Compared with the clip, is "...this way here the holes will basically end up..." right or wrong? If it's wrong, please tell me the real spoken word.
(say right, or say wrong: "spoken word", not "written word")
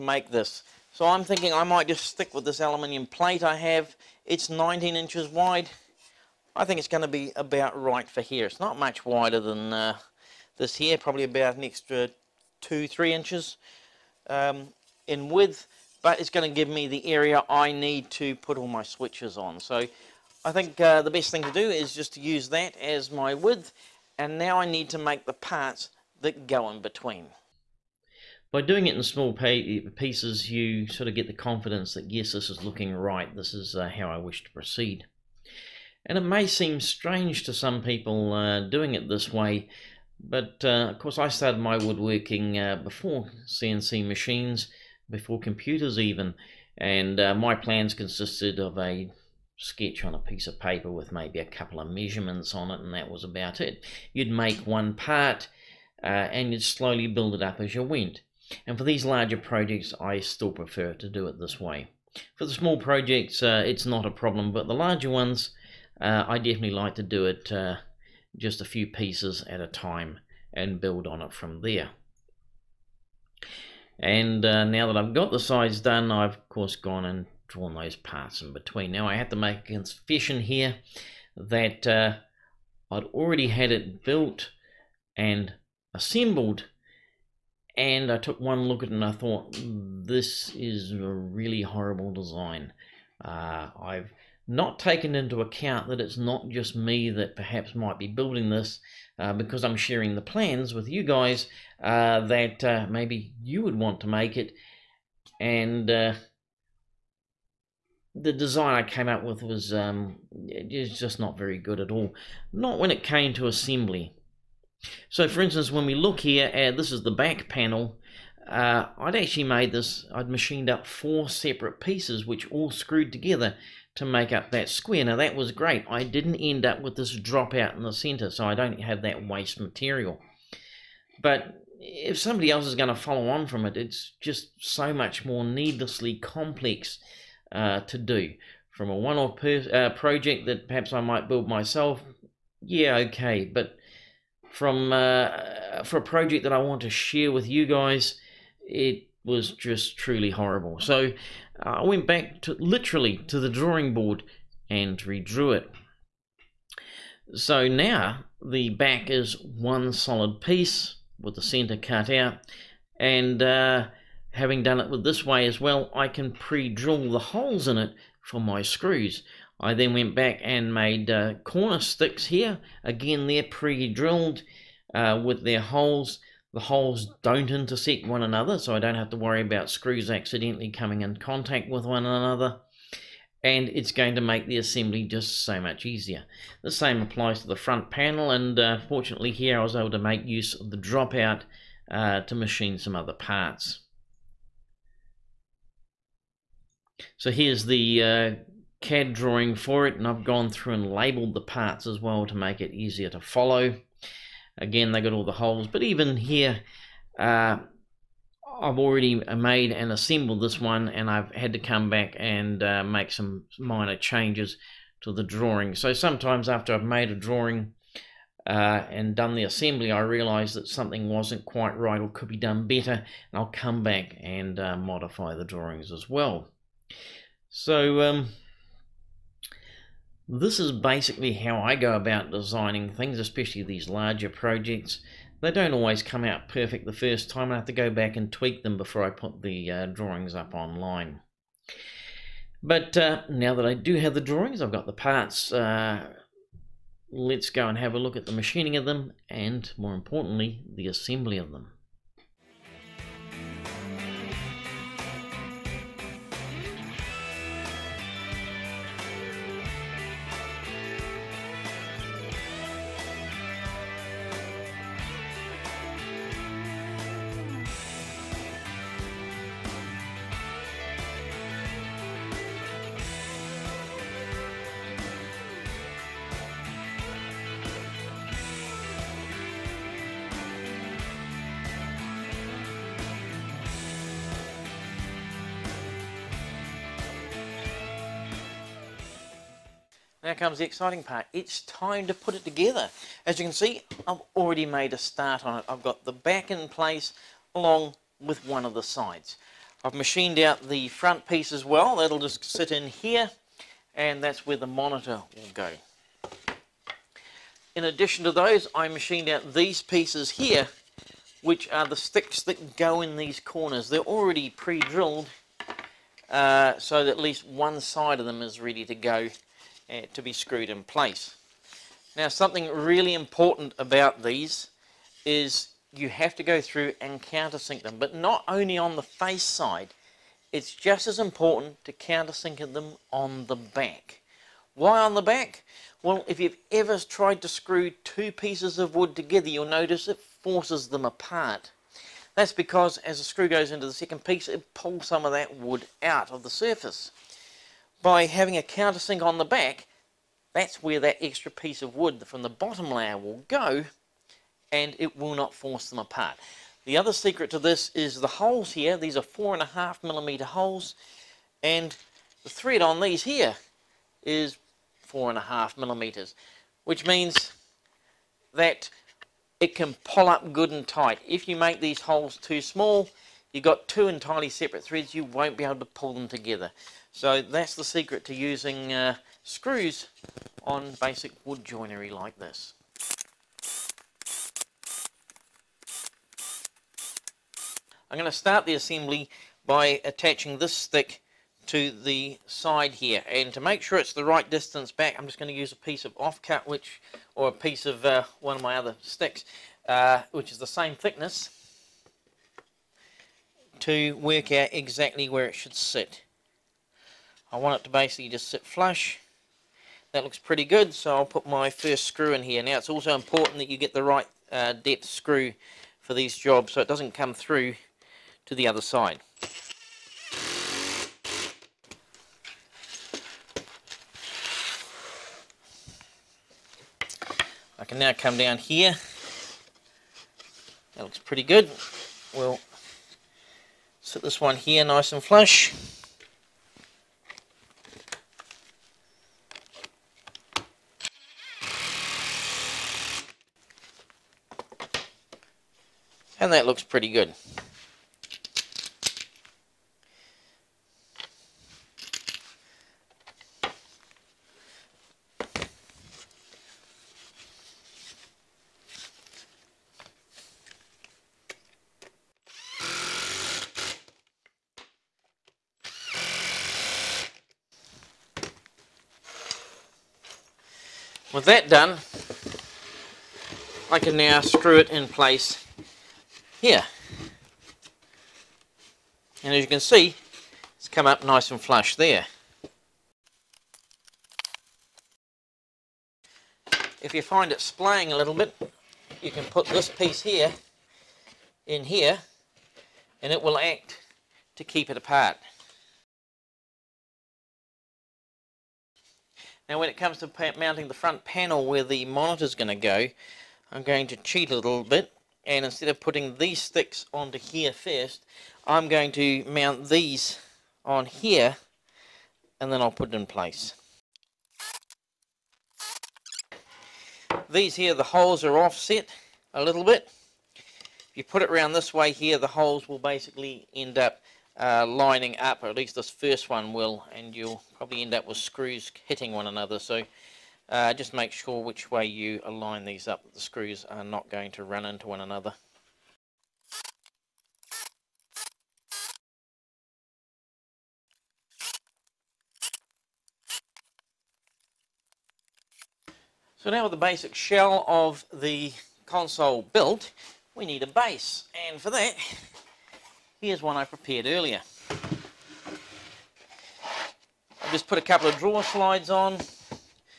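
right.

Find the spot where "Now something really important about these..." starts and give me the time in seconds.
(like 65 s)
322 s.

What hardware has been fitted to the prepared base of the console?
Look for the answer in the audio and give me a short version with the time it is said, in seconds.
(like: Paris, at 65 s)
Drawer slides, at 558 s.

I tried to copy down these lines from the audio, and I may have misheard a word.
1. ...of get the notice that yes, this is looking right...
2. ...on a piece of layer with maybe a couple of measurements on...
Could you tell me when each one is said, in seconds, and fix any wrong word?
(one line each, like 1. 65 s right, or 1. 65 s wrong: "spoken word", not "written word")
1. 31 s wrong: "confidence", not "notice"
2. 50 s wrong: "paper", not "layer".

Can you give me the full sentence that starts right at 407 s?
I want it to basically just sit flush.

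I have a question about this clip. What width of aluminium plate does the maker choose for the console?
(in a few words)
19 inches.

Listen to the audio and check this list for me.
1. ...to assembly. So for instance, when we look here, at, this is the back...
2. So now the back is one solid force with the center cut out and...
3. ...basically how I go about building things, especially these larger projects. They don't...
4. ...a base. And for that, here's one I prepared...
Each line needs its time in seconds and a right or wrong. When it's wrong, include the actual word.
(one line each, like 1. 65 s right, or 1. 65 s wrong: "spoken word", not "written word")
1. 113 s right
2. 157 s wrong: "piece", not "force"
3. 230 s wrong: "designing", not "building"
4. 550 s right.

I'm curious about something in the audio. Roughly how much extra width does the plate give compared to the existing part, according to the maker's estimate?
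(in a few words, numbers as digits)
2-3 inches.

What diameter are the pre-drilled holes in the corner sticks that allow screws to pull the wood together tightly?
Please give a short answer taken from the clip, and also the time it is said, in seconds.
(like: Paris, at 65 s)
4.5 millimeters, at 359 s.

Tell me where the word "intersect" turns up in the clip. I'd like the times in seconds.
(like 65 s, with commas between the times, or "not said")
177 s.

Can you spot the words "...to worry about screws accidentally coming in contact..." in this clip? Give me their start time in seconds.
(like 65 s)
179 s.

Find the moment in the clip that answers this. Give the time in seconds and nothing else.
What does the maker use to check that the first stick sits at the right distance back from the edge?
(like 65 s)
396 s.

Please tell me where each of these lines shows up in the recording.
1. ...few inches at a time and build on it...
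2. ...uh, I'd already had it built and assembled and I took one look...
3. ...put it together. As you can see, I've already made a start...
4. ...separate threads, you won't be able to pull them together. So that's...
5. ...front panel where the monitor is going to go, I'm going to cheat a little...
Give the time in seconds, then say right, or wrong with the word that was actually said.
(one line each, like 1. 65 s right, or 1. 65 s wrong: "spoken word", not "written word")
1. 68 s wrong: "pieces", not "inches"
2. 81 s right
3. 292 s right
4. 374 s right
5. 500 s right.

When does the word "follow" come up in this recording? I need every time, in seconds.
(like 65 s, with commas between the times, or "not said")
132 s, 203 s.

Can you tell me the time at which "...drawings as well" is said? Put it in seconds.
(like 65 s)
225 s.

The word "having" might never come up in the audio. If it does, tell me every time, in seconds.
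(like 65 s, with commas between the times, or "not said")
164 s, 348 s.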